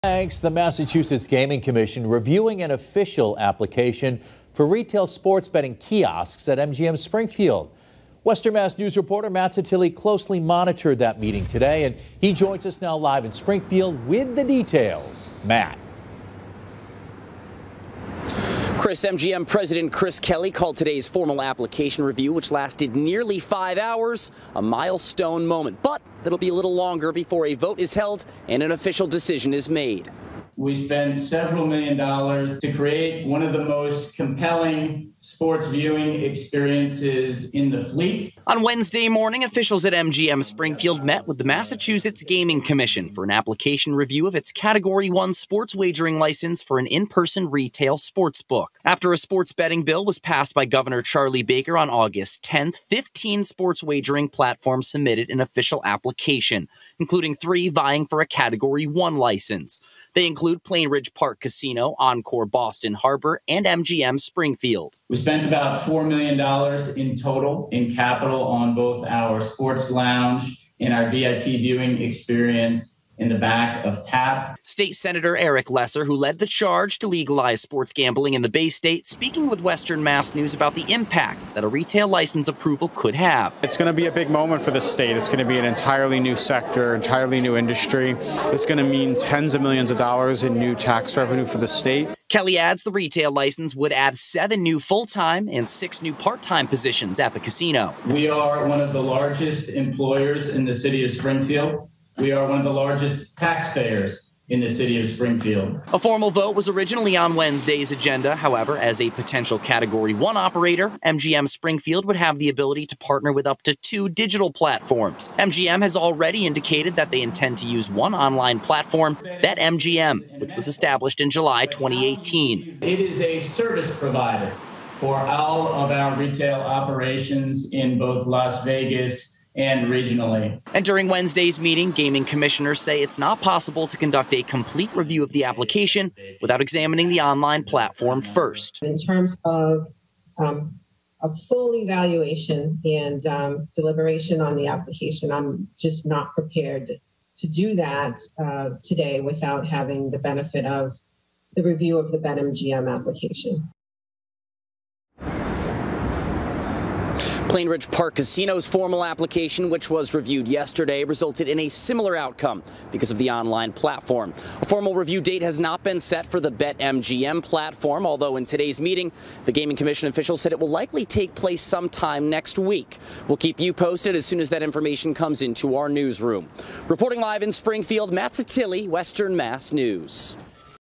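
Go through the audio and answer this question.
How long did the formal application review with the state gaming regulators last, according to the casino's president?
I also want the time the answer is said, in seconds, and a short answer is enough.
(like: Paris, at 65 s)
nearly five hours, at 22 s.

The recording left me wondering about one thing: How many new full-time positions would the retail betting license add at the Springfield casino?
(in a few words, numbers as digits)
7.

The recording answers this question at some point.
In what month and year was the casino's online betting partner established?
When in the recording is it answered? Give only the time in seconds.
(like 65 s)
121 s.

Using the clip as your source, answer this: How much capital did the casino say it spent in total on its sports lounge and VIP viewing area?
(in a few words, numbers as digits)
$4 million.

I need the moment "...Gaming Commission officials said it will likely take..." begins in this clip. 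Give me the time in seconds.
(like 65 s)
169 s.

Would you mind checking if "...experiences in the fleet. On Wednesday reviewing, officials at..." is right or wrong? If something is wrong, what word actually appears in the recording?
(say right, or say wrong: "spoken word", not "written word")
wrong: "morning", not "reviewing".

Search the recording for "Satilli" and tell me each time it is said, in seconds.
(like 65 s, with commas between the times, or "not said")
9 s, 178 s.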